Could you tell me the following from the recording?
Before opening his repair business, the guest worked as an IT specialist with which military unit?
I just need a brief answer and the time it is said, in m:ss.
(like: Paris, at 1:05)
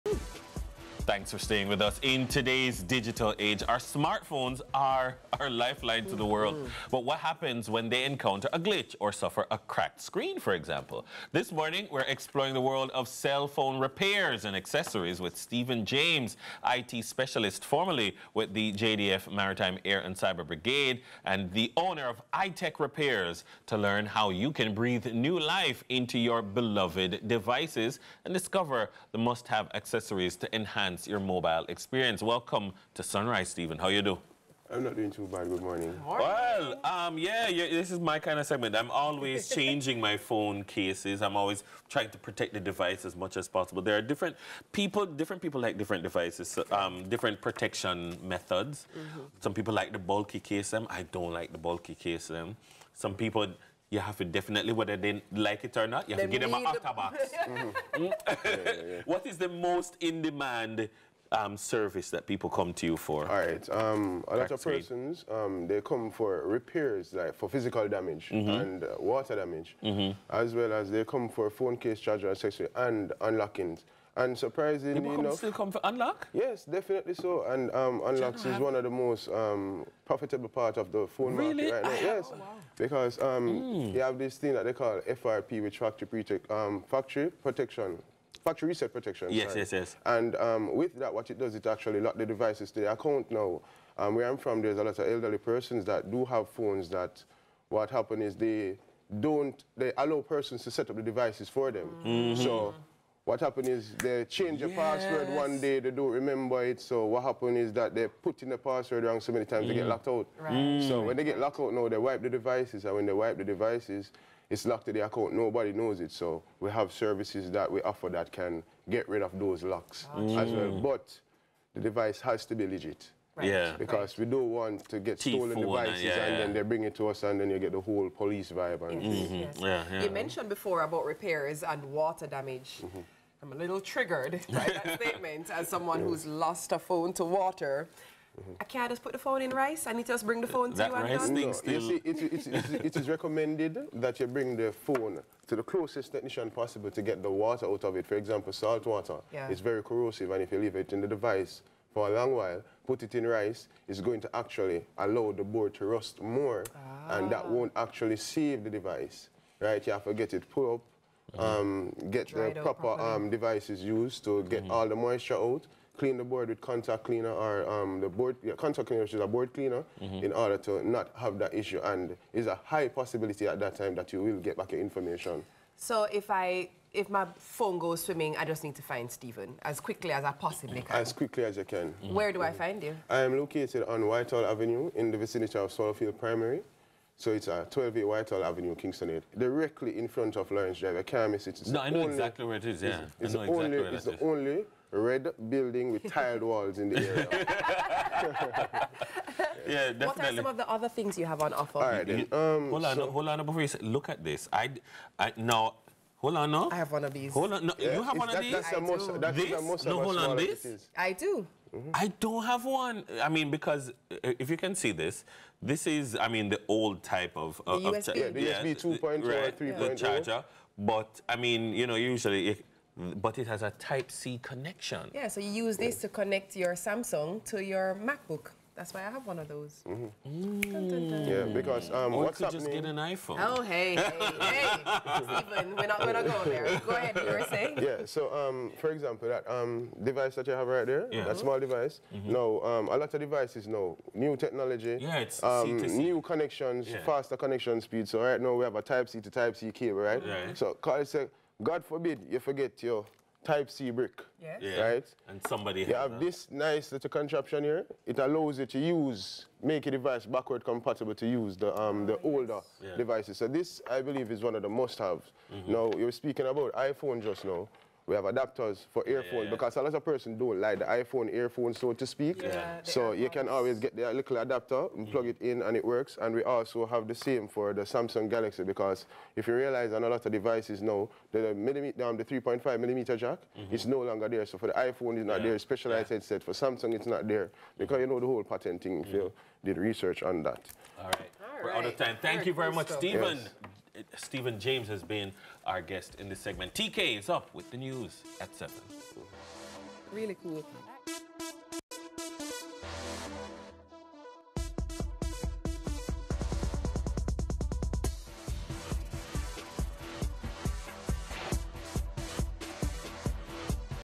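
JDF Maritime Air and Cyber Brigade, at 0:18.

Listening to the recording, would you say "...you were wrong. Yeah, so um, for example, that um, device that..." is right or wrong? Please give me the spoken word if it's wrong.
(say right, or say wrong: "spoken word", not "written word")
wrong: "saying", not "wrong".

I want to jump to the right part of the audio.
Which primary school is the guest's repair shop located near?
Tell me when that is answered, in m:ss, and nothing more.
3:05.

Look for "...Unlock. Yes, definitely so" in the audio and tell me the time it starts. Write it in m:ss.
1:15.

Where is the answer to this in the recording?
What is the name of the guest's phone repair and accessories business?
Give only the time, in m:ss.
0:22.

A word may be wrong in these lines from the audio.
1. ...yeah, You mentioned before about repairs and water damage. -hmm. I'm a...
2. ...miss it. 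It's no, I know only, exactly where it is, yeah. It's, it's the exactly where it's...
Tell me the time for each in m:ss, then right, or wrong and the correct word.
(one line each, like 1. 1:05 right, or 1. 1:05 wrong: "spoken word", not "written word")
1. 2:09 right
2. 3:11 right.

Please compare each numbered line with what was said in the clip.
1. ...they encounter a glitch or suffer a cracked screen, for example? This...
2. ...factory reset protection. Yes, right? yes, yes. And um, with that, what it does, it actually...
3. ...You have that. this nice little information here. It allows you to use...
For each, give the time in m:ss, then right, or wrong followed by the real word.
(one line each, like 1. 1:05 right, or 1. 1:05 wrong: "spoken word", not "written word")
1. 0:07 right
2. 1:28 right
3. 4:15 wrong: "contraption", not "information".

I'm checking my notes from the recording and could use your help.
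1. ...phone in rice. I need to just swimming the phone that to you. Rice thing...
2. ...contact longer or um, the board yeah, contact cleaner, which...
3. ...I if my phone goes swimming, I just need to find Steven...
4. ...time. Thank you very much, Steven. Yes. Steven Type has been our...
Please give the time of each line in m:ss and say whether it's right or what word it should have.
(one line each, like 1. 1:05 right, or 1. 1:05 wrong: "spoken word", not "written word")
1. 2:19 wrong: "bring", not "swimming"
2. 2:46 wrong: "cleaner", not "longer"
3. 2:56 right
4. 4:51 wrong: "James", not "Type".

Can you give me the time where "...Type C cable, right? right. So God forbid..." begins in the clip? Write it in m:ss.
4:09.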